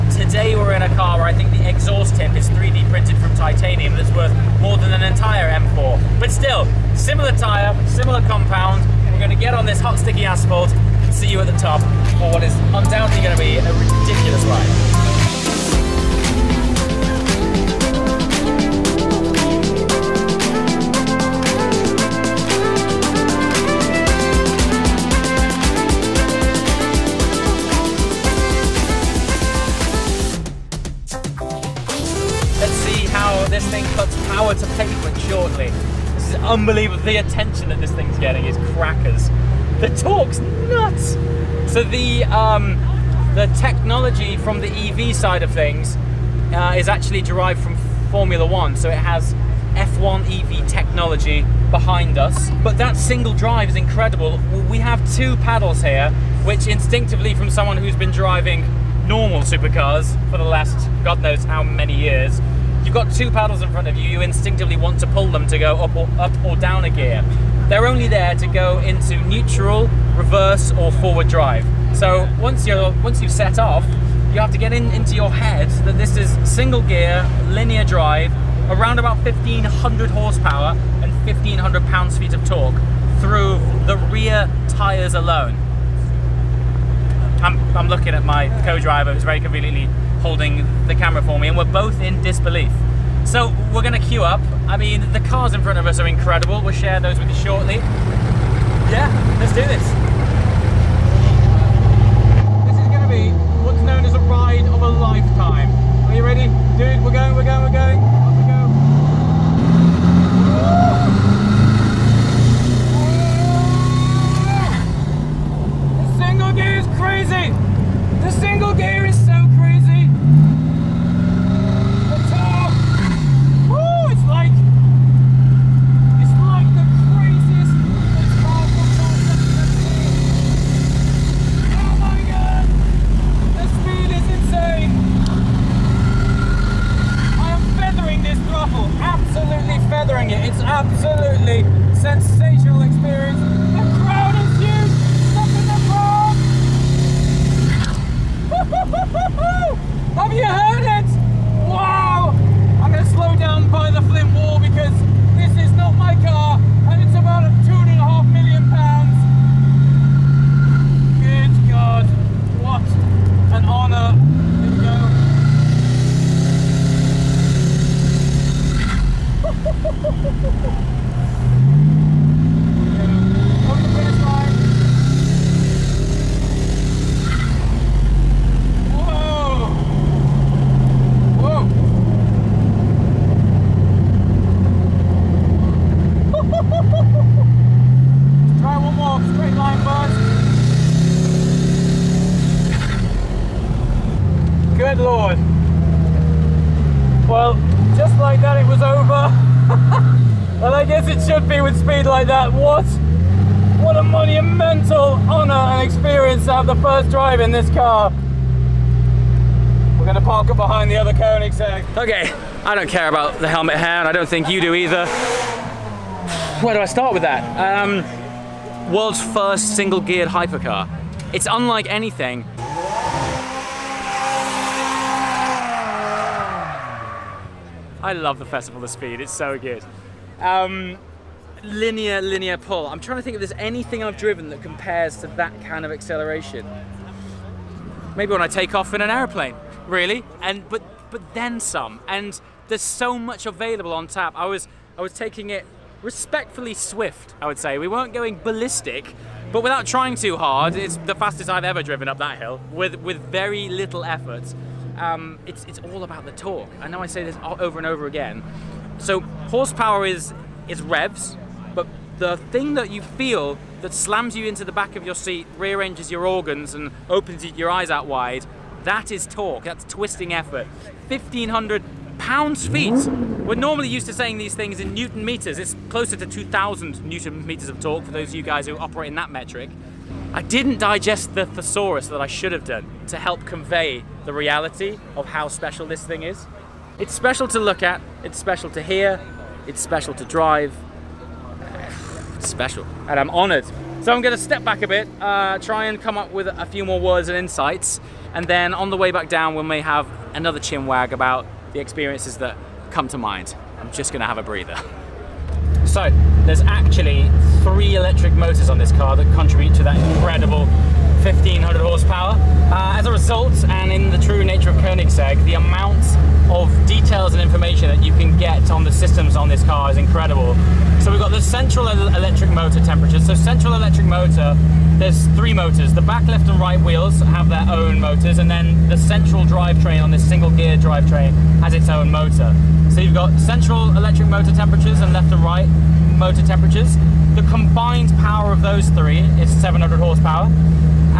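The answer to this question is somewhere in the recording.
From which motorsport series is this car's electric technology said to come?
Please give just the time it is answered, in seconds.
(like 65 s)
48 s.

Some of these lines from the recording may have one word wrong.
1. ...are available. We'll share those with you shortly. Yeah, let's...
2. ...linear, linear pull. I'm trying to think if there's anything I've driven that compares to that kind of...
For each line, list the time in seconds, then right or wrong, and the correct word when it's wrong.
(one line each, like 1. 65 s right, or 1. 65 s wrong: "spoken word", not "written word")
1. 95 s wrong: "incredible", not "available"
2. 231 s right.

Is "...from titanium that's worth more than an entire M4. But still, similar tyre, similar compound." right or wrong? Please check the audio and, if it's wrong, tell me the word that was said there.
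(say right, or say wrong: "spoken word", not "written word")
right.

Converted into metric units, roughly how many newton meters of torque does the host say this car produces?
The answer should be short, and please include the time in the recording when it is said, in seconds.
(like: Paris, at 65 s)
2,000, at 276 s.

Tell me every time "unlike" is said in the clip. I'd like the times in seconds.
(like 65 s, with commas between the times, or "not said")
221 s.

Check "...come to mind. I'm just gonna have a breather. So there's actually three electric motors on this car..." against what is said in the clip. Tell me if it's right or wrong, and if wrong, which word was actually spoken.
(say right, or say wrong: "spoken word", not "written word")
right.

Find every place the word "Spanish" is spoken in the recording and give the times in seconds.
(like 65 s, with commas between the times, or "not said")
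not said.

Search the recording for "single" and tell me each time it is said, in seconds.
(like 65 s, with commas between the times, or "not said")
52 s, 76 s, 219 s, 330 s.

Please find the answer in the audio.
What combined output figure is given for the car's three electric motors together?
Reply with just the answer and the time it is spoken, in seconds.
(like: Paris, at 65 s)
700 horsepower, at 339 s.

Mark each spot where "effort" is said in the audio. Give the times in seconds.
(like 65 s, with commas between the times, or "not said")
254 s, 270 s.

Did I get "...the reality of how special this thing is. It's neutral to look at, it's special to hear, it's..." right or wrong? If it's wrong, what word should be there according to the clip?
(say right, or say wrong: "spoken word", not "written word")
wrong: "special", not "neutral".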